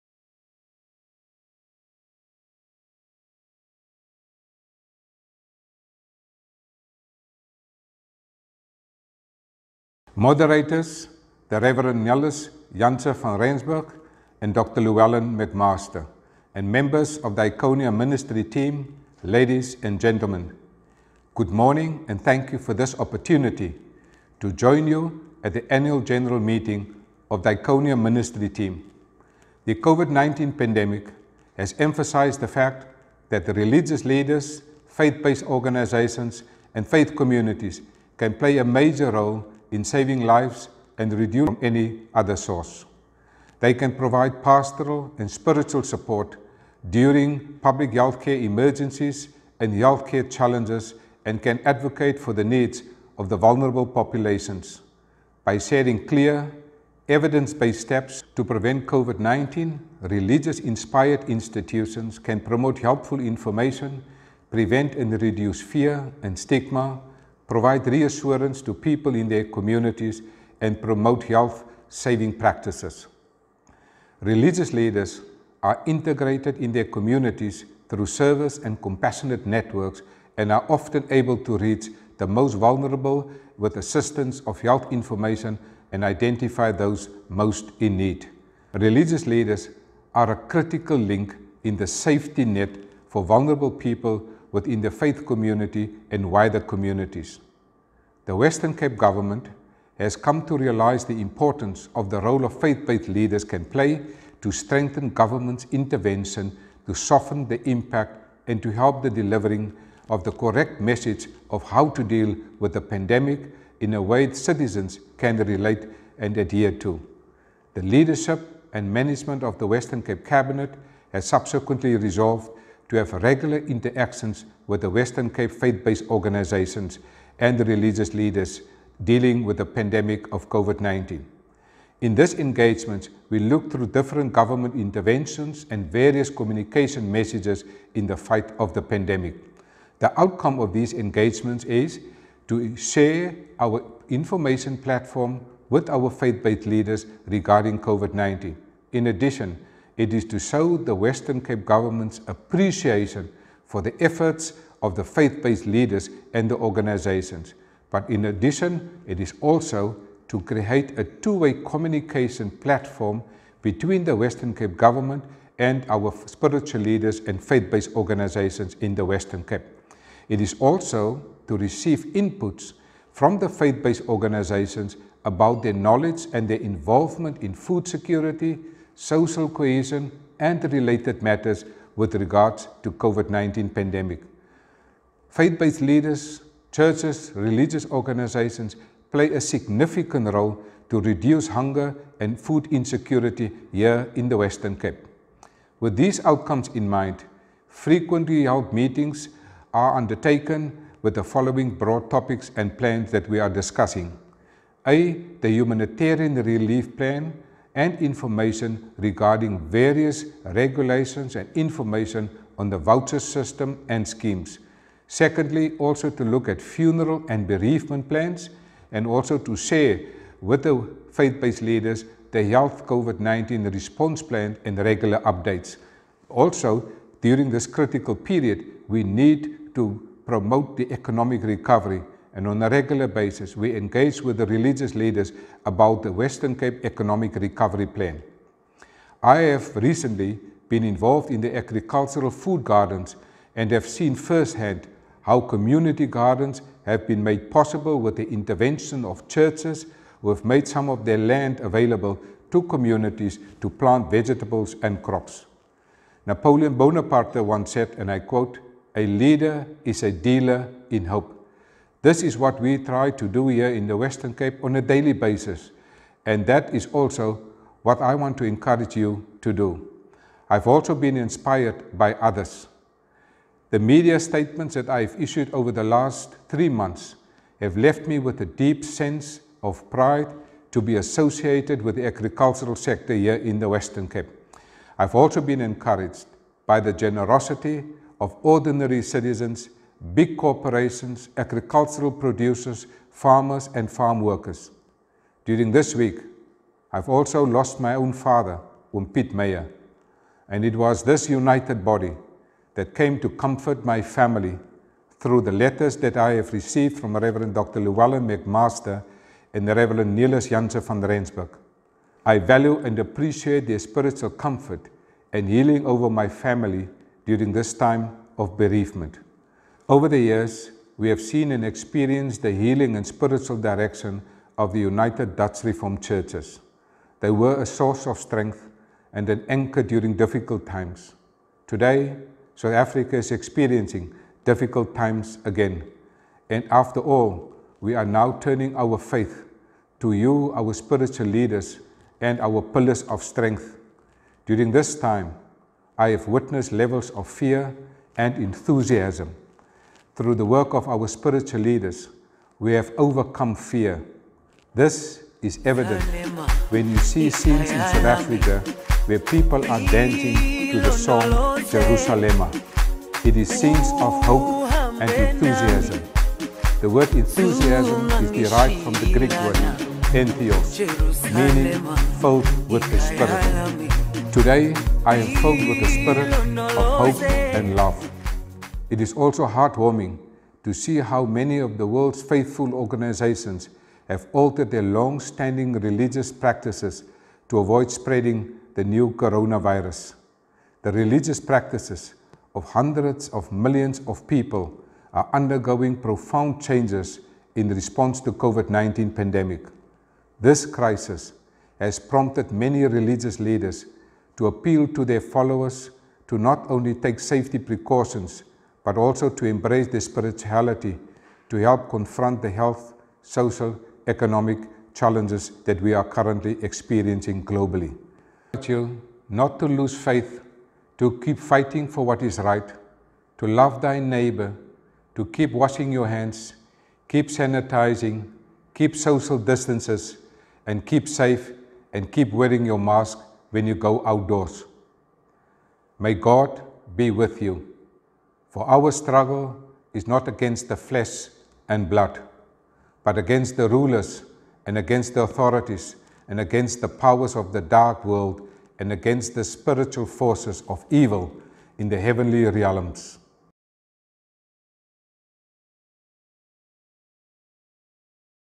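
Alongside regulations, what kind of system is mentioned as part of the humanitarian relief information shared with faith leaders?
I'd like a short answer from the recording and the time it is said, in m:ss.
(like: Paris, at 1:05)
voucher system, at 3:32.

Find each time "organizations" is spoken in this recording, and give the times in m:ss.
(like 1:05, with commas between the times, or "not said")
0:35, 2:06, 2:36, 2:47, 2:54, 3:07, 6:22.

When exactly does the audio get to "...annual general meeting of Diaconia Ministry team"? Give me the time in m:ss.
0:25.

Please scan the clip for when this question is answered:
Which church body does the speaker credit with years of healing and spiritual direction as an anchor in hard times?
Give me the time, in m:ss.
5:24.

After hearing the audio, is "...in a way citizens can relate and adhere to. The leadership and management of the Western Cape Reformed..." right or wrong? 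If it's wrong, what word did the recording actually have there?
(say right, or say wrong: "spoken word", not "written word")
wrong: "Cabinet", not "Reformed".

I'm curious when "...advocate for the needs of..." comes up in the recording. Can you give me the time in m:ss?
0:51.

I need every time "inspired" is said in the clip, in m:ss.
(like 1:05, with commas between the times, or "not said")
1:00, 4:31.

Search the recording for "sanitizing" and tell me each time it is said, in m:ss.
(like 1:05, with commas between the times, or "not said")
7:07.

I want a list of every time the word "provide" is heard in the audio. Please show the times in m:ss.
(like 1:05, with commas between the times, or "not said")
0:43, 1:07.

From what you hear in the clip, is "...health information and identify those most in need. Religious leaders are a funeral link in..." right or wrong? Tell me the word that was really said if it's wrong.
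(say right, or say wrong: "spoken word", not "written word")
wrong: "critical", not "funeral".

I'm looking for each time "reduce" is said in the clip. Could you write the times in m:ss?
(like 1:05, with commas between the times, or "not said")
0:41, 1:05, 3:11.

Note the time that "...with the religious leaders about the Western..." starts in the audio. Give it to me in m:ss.
3:54.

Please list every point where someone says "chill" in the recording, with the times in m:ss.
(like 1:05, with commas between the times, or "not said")
not said.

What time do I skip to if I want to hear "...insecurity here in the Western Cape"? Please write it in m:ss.
3:12.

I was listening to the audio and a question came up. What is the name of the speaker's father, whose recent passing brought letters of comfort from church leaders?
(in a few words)
Piet Meyer.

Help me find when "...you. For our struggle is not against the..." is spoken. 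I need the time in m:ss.
7:17.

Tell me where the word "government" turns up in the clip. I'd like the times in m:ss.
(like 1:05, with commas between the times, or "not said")
1:38, 1:45, 2:14, 2:31, 2:44.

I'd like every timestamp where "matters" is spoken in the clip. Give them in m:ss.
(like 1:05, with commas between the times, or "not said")
3:01.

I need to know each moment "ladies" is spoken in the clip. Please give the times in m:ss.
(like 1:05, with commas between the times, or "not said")
0:19.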